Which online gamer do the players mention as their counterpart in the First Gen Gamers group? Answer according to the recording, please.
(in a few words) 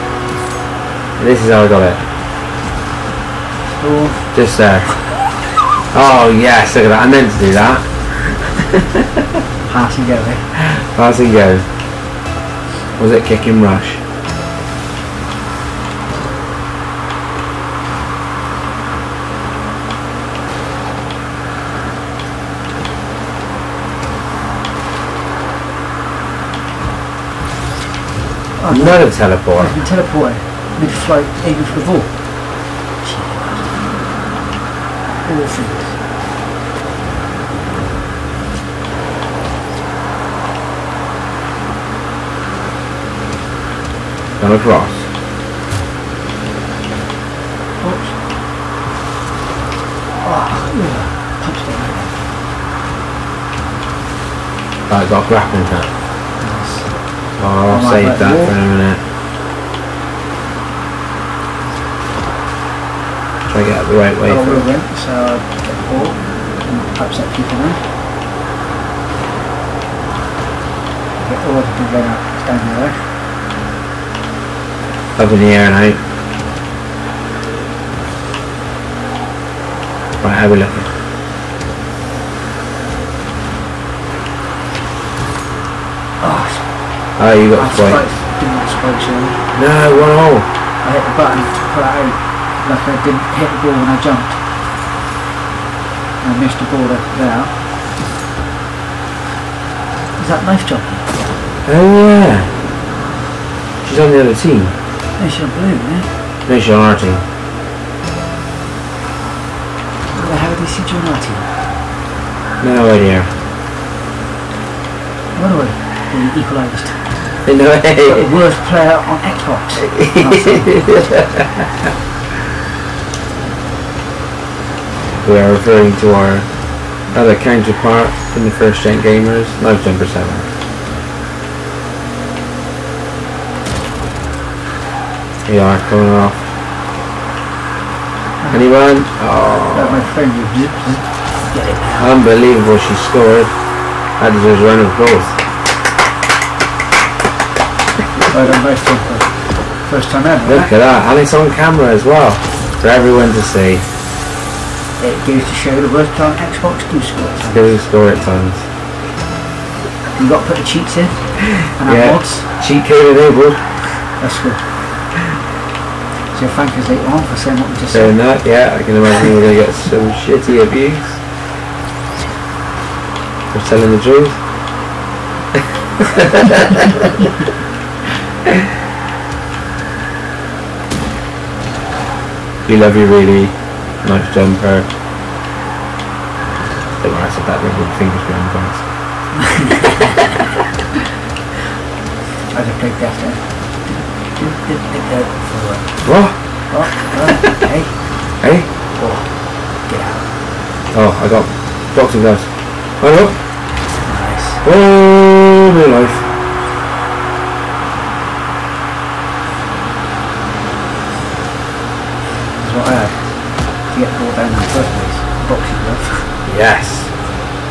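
Live Jumper 7.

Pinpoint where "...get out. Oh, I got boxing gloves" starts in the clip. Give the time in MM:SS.
03:19.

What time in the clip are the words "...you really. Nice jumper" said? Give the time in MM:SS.
03:02.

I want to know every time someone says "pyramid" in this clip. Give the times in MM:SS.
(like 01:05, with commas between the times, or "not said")
not said.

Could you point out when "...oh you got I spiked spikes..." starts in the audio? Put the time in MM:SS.
01:27.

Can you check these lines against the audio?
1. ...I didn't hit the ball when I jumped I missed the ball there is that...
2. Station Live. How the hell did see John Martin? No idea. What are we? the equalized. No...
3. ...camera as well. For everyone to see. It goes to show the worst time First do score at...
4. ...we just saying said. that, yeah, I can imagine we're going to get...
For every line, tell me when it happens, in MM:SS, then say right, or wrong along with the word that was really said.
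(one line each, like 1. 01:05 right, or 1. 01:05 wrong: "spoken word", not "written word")
1. 01:32 right
2. 01:46 wrong: "Martin", not "Live"
3. 02:31 wrong: "Xbox", not "First"
4. 02:47 right.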